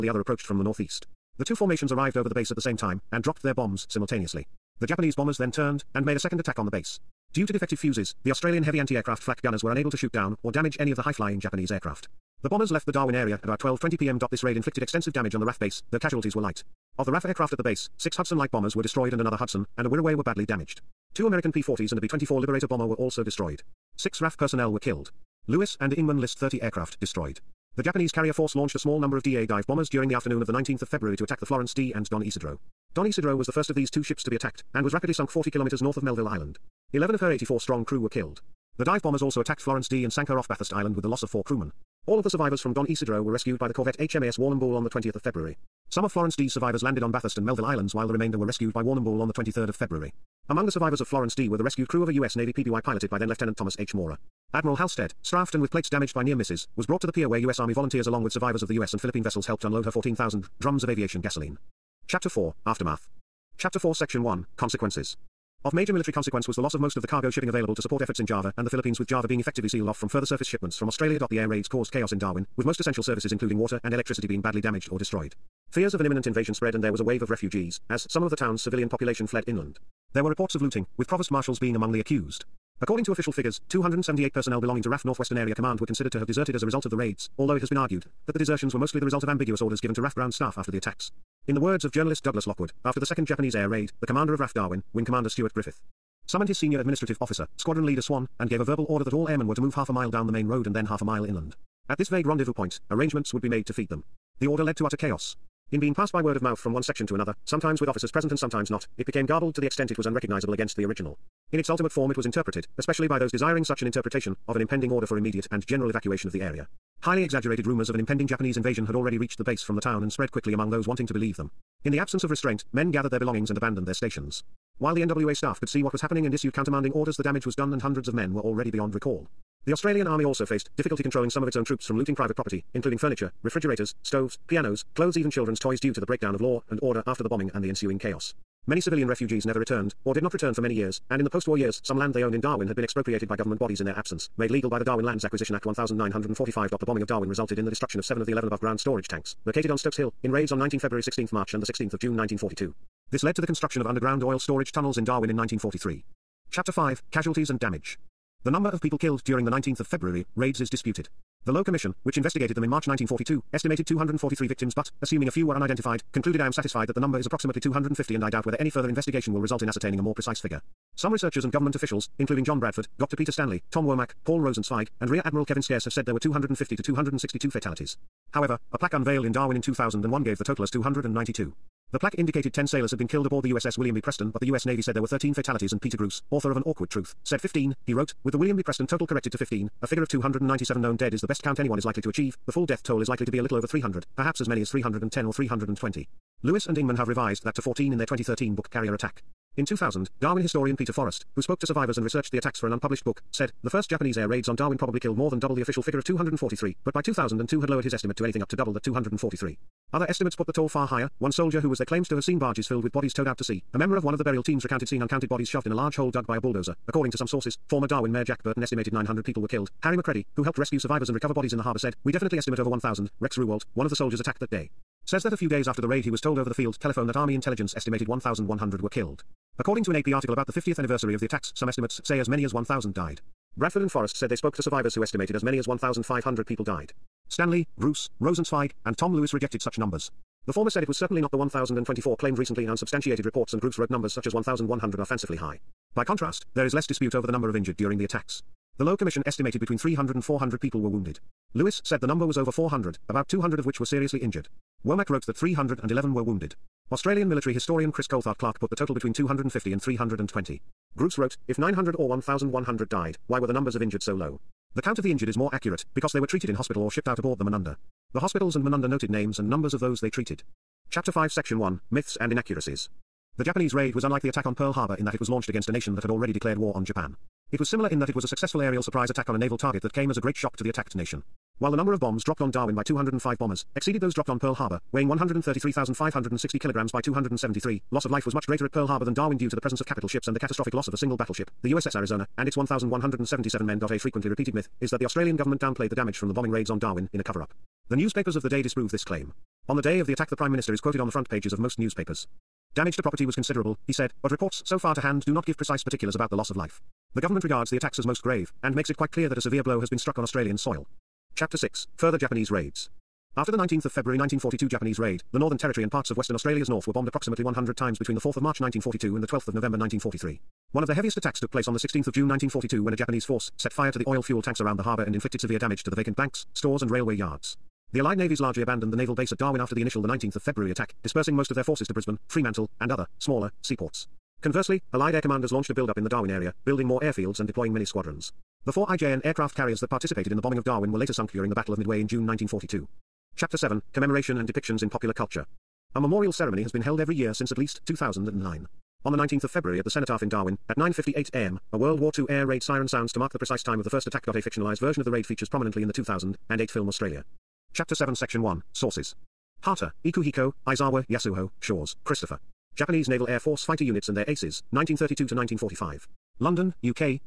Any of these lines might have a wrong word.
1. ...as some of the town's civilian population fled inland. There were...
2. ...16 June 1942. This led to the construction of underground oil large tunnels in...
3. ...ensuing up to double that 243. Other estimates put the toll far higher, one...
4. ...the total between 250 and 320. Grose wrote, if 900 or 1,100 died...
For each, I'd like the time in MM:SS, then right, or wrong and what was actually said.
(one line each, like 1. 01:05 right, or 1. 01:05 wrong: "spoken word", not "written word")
1. 01:17 right
2. 02:31 wrong: "storage", not "large"
3. 03:28 wrong: "anything", not "ensuing"
4. 04:18 right.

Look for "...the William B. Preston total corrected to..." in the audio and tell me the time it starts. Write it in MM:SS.
03:08.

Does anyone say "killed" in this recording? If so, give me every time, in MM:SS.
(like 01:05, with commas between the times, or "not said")
00:24, 00:38, 02:38, 03:03, 03:24, 03:39, 03:48.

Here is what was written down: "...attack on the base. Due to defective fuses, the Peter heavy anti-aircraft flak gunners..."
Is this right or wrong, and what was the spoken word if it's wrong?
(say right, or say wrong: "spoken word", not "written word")
wrong: "Australian", not "Peter".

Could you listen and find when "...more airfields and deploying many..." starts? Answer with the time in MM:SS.
05:36.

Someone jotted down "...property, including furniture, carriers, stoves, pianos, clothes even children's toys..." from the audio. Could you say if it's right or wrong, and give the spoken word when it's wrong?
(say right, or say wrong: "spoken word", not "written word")
wrong: "refrigerators", not "carriers".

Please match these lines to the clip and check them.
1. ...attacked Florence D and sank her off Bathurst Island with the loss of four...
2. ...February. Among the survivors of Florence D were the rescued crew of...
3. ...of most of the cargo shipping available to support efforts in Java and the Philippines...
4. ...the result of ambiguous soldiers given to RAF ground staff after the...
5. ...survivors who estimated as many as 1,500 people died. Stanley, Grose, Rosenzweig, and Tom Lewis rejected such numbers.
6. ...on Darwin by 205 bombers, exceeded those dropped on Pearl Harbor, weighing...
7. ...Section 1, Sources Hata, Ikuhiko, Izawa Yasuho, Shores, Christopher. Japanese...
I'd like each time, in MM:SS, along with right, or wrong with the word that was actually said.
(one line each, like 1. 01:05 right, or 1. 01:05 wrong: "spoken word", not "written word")
1. 00:39 right
2. 00:49 right
3. 01:06 right
4. 01:28 wrong: "orders", not "soldiers"
5. 03:54 right
6. 04:42 right
7. 05:58 right.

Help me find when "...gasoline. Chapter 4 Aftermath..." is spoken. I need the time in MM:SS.
01:01.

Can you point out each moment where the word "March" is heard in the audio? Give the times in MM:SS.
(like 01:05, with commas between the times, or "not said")
02:31, 02:42, 05:18.